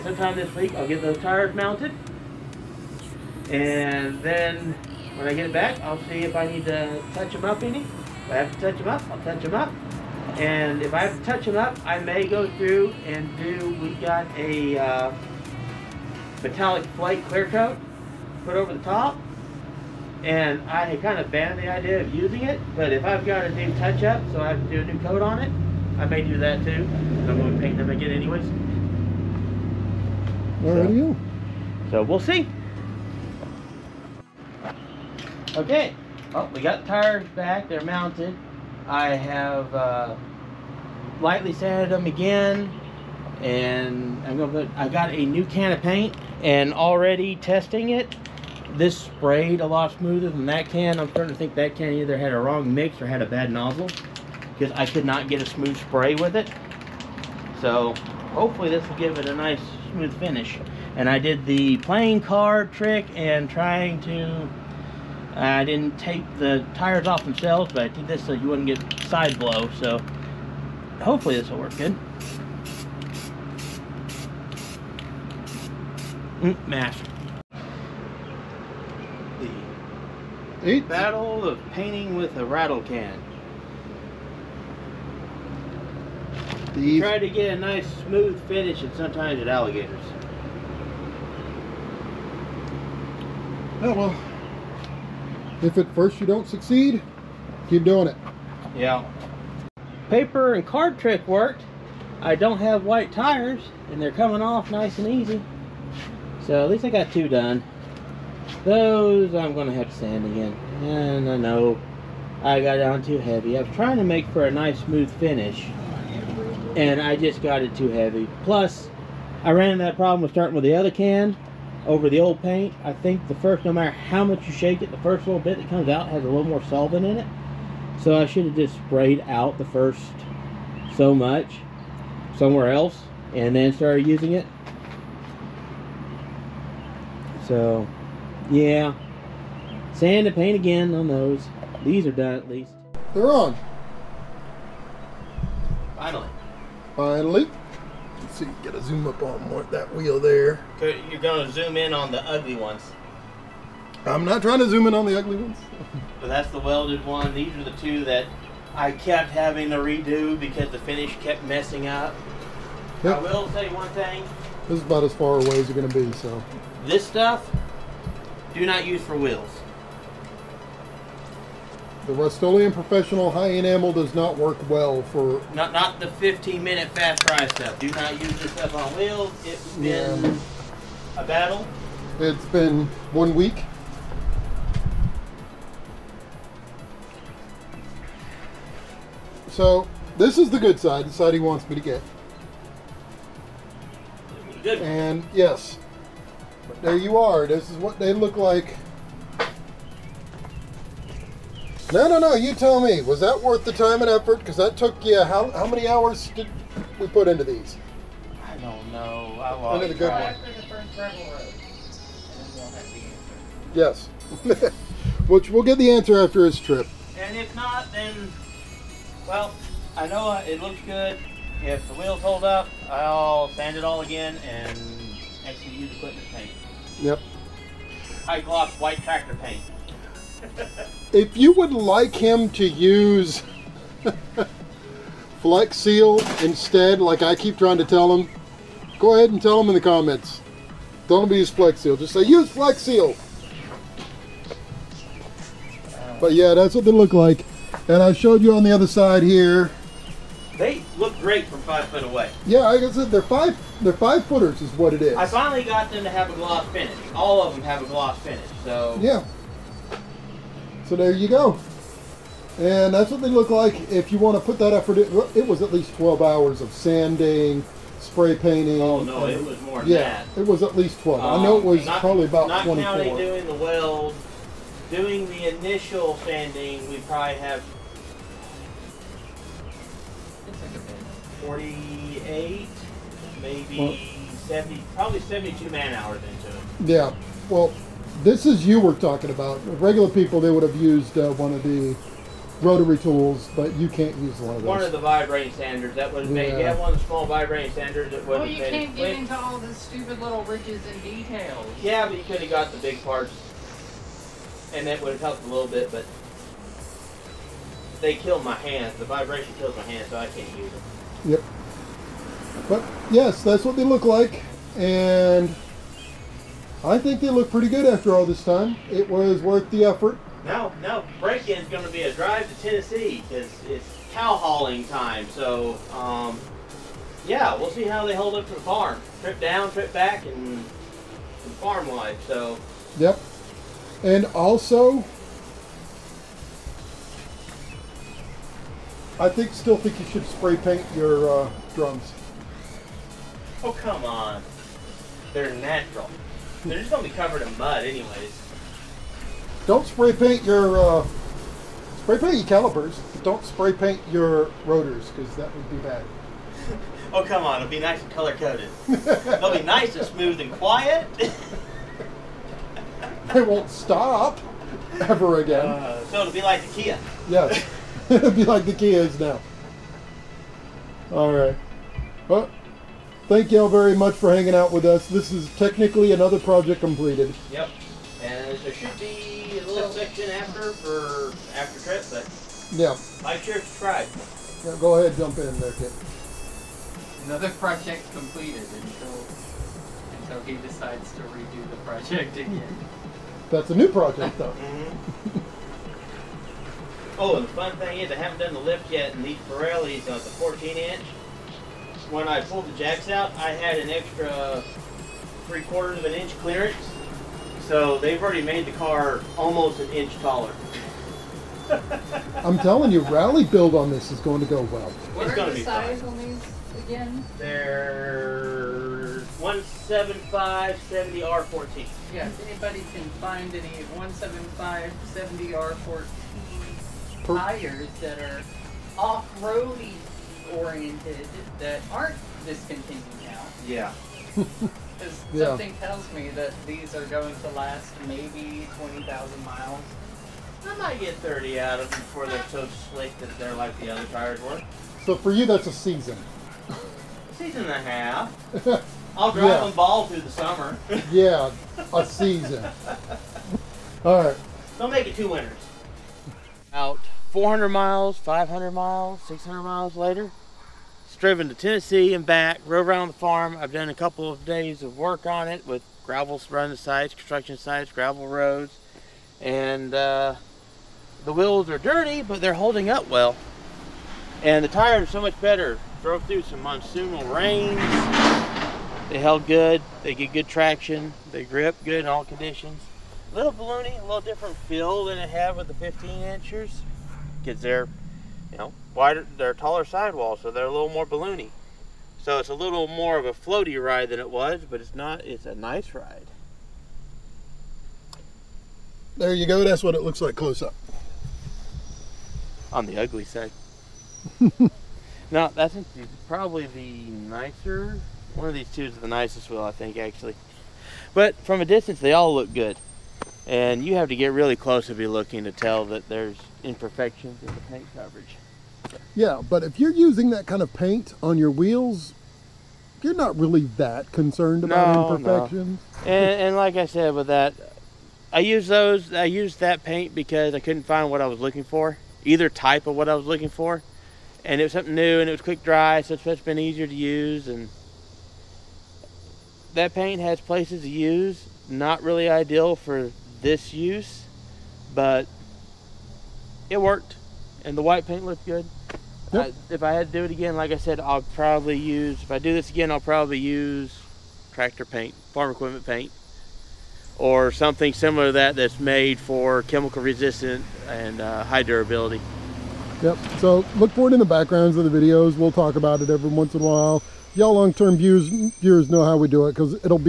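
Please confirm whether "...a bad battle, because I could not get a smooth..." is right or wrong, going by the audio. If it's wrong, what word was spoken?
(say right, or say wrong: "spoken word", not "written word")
wrong: "nozzle", not "battle".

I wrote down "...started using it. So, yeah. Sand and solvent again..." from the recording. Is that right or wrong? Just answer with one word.
wrong.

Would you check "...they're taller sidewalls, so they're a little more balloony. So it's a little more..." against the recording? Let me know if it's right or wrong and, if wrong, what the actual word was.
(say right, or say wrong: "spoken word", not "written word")
right.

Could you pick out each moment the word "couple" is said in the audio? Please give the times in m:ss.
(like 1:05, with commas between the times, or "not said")
7:43.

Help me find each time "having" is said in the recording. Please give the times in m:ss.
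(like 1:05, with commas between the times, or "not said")
2:39.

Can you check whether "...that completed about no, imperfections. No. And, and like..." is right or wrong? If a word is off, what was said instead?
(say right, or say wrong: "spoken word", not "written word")
wrong: "concerned", not "completed".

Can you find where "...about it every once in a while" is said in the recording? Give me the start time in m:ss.
9:25.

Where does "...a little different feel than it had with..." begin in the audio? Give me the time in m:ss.
8:03.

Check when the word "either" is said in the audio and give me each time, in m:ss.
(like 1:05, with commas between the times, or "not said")
0:51, 8:52.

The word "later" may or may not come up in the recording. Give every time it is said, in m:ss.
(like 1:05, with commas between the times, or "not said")
7:39.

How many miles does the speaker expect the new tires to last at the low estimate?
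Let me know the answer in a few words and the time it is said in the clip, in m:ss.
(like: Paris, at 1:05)
20,000, at 7:18.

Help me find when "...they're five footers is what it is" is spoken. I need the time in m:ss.
4:13.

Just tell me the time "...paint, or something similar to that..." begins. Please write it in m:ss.
9:15.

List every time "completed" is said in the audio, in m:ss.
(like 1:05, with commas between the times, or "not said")
6:16, 6:28.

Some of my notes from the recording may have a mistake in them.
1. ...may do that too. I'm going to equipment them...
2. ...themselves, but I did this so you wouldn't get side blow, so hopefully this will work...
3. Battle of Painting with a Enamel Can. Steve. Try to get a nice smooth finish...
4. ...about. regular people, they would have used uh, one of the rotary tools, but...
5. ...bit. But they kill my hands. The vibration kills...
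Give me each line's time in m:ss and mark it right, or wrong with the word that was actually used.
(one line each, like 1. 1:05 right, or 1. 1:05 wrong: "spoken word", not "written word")
1. 0:26 wrong: "paint", not "equipment"
2. 1:07 right
3. 1:20 wrong: "Rattle", not "Enamel"
4. 4:49 right
5. 5:05 right.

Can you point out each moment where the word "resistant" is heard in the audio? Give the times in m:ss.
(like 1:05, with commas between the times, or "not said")
9:20.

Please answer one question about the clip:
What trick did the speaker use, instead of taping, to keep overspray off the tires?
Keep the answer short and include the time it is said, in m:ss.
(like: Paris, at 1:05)
Playing card trick, at 1:01.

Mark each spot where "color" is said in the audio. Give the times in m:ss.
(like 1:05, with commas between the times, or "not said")
5:58.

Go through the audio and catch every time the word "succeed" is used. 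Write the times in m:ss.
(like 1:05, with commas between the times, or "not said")
1:36.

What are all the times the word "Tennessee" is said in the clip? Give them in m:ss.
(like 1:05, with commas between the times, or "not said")
5:22, 7:41.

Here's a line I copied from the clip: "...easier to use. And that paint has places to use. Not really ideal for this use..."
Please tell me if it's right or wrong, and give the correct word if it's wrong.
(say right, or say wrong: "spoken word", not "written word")
right.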